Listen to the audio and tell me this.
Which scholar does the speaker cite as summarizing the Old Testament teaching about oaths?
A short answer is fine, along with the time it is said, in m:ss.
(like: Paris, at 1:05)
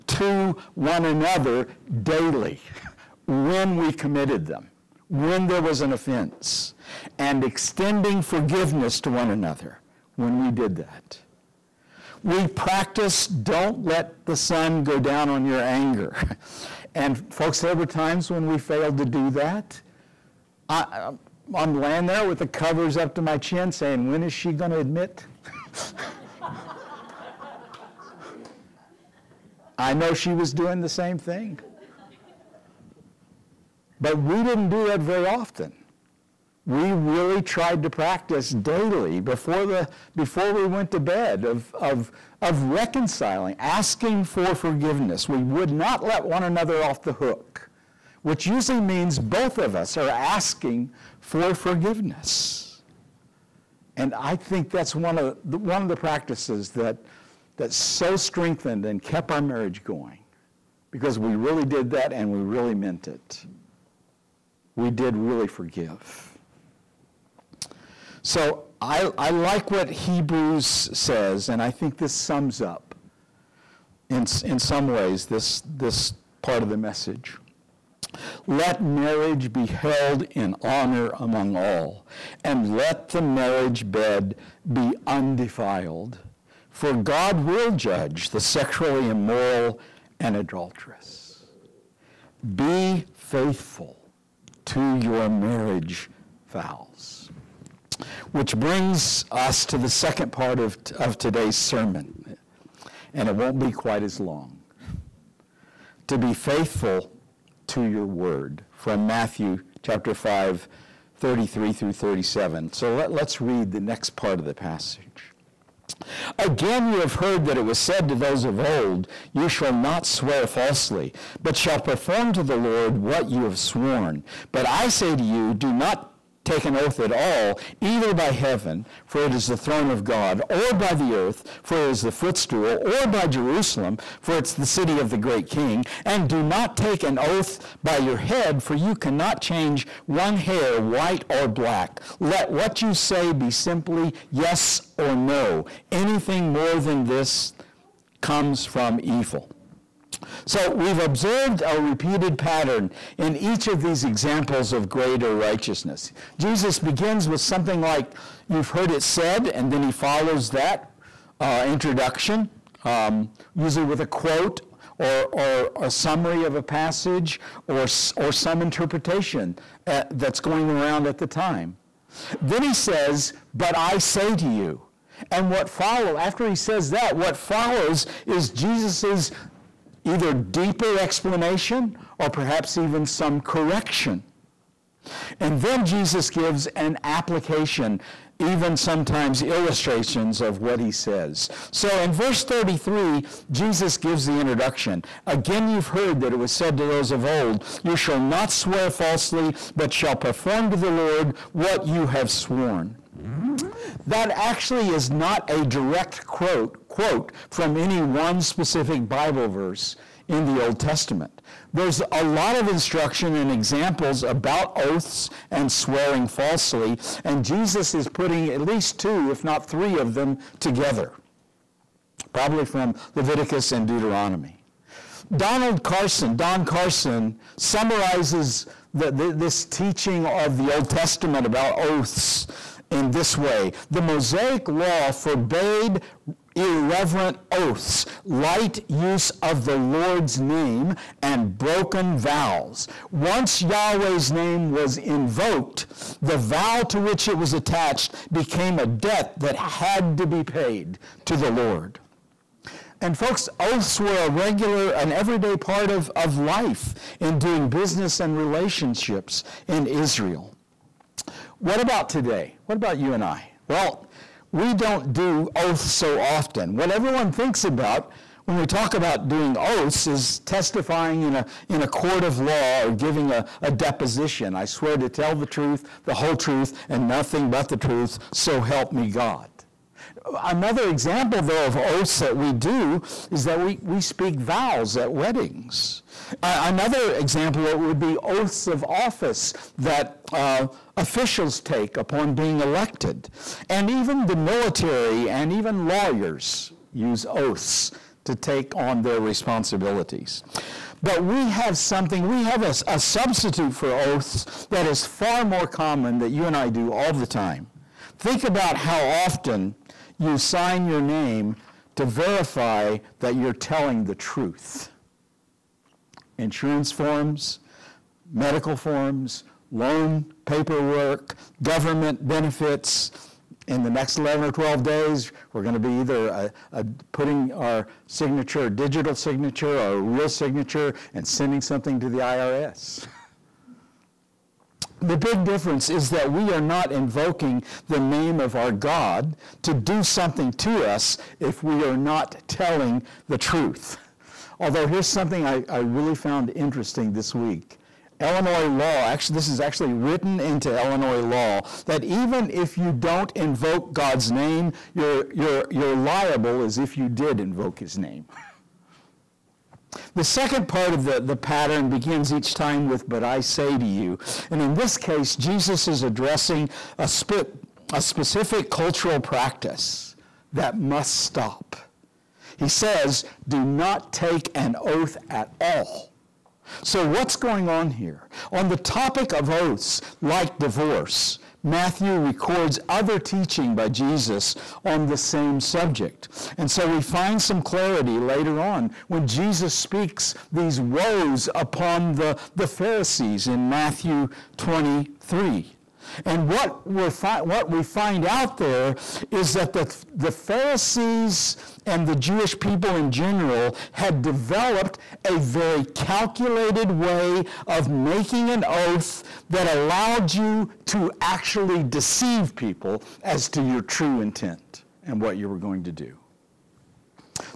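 Don Carson, at 3:46.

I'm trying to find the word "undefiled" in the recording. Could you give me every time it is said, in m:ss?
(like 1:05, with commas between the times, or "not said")
1:25.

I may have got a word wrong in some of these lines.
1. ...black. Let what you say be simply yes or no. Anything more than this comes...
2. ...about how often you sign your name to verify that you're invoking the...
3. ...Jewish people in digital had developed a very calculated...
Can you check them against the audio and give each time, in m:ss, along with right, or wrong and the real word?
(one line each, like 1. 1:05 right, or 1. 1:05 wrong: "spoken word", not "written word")
1. 2:21 right
2. 5:08 wrong: "telling", not "invoking"
3. 6:42 wrong: "general", not "digital".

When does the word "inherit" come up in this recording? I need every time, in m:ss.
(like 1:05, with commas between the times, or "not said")
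not said.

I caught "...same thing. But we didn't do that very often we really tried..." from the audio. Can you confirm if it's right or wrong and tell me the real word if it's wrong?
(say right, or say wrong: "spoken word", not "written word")
right.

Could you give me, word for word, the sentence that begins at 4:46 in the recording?
Uh, another example would be oaths of office that uh, officials take upon being elected.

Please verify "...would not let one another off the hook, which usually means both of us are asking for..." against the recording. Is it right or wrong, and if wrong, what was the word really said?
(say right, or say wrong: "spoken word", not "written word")
right.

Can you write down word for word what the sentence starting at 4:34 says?
I swear to tell the truth, the whole truth, and nothing but the truth, so help me God.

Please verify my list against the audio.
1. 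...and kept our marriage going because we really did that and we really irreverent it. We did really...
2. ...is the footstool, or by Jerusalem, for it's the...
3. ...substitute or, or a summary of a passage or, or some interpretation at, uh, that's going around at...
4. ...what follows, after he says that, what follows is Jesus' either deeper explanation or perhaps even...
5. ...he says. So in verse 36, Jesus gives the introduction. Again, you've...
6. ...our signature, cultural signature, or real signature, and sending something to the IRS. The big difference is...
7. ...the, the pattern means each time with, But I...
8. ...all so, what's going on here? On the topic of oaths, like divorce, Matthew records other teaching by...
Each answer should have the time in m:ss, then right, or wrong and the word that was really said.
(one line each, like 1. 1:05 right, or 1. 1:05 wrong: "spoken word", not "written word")
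1. 0:58 wrong: "meant", not "irreverent"
2. 2:11 right
3. 2:44 wrong: "quote", not "substitute"
4. 2:55 right
5. 3:10 wrong: "33", not "36"
6. 5:27 wrong: "digital", not "cultural"
7. 6:01 wrong: "begins", not "means"
8. 6:15 right.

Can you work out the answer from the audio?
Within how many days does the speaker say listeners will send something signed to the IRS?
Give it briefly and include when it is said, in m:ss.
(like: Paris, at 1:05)
11 or 12, at 5:24.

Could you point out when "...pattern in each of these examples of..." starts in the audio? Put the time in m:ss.
2:32.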